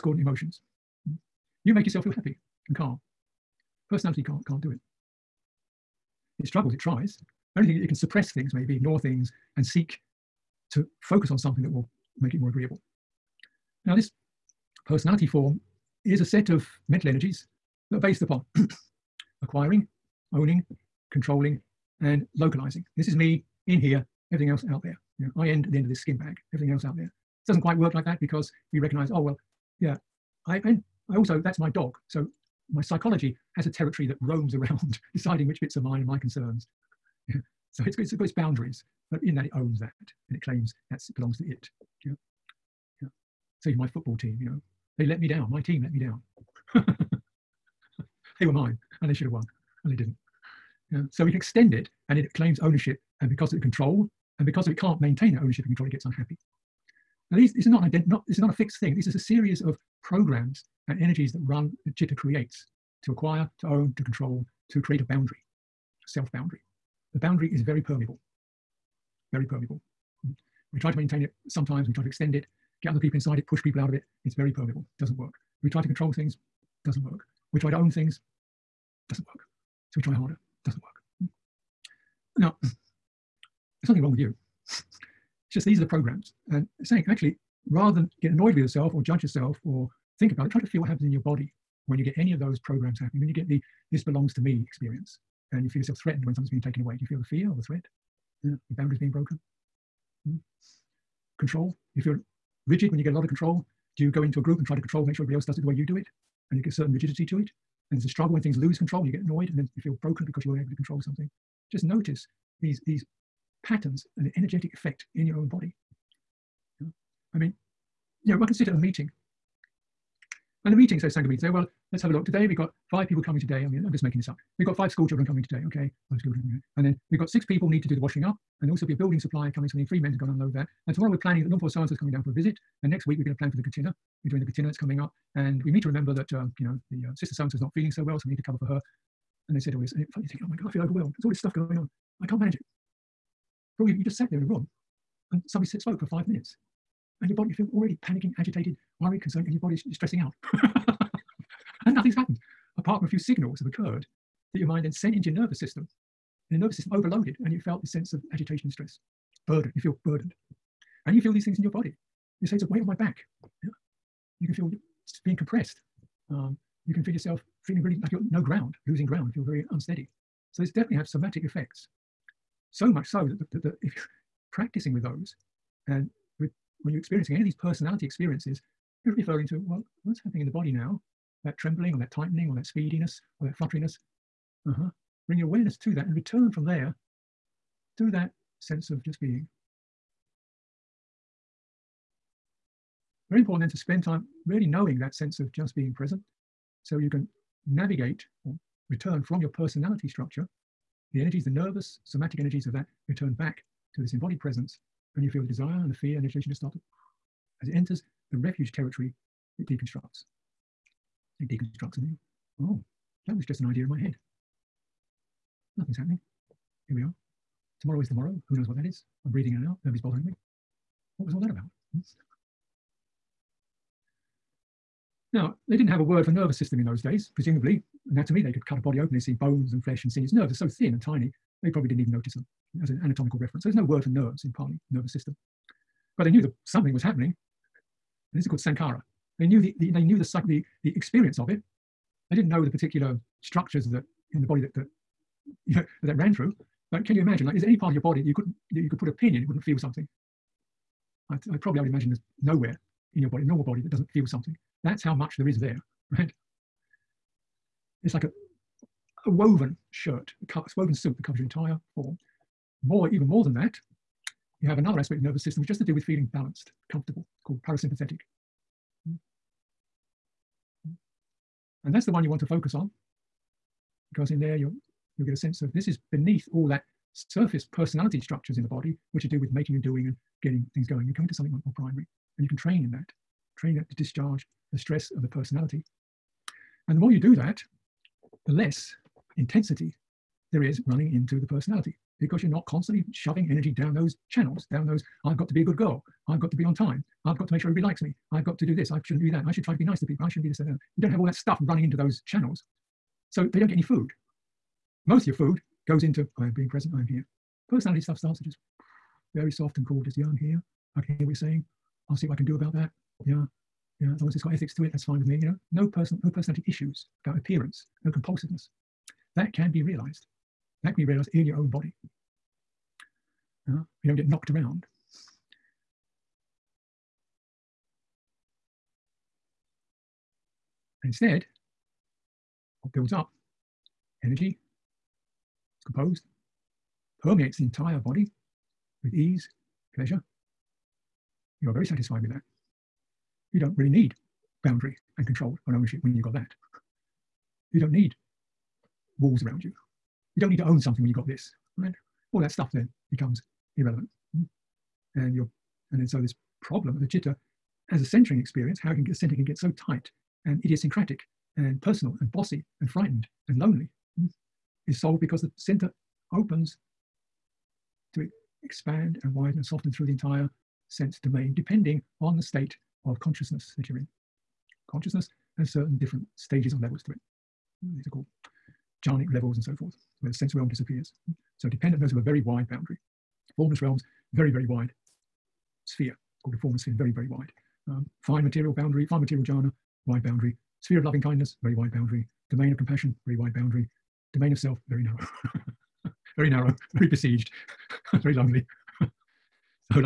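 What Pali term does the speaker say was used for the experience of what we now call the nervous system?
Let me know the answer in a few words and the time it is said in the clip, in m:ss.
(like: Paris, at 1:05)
sankhara, at 3:58.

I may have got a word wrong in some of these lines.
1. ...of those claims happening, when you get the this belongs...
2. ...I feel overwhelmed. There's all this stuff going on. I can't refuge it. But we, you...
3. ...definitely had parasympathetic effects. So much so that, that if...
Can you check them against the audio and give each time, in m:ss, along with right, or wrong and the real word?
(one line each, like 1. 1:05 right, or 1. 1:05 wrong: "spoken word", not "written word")
1. 1:32 wrong: "programs", not "claims"
2. 2:20 wrong: "manage", not "refuge"
3. 2:50 wrong: "somatic", not "parasympathetic".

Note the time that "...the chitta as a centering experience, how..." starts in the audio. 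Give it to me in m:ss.
5:57.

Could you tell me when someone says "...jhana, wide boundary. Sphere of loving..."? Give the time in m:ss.
6:29.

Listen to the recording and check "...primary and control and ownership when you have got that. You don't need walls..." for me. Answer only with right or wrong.
wrong.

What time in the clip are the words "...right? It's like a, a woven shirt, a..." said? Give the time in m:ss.
4:16.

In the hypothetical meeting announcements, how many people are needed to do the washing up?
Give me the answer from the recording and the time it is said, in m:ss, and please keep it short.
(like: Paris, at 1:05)
6, at 2:07.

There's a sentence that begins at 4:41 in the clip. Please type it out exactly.
You come into something more, more primary, and you can train in that, training that to discharge the stress of the personality.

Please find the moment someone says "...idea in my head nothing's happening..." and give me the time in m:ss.
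3:33.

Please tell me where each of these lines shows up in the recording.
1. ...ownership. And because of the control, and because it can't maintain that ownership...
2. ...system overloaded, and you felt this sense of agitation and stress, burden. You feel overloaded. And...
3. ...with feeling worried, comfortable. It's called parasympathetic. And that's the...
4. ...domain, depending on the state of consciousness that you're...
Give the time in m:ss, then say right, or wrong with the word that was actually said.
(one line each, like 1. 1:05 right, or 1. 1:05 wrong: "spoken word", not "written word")
1. 0:52 right
2. 2:36 wrong: "burdened", not "overloaded"
3. 4:25 wrong: "balanced", not "worried"
4. 6:11 right.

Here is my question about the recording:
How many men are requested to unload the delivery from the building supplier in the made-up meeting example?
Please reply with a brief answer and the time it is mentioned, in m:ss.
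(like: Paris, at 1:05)
3, at 2:09.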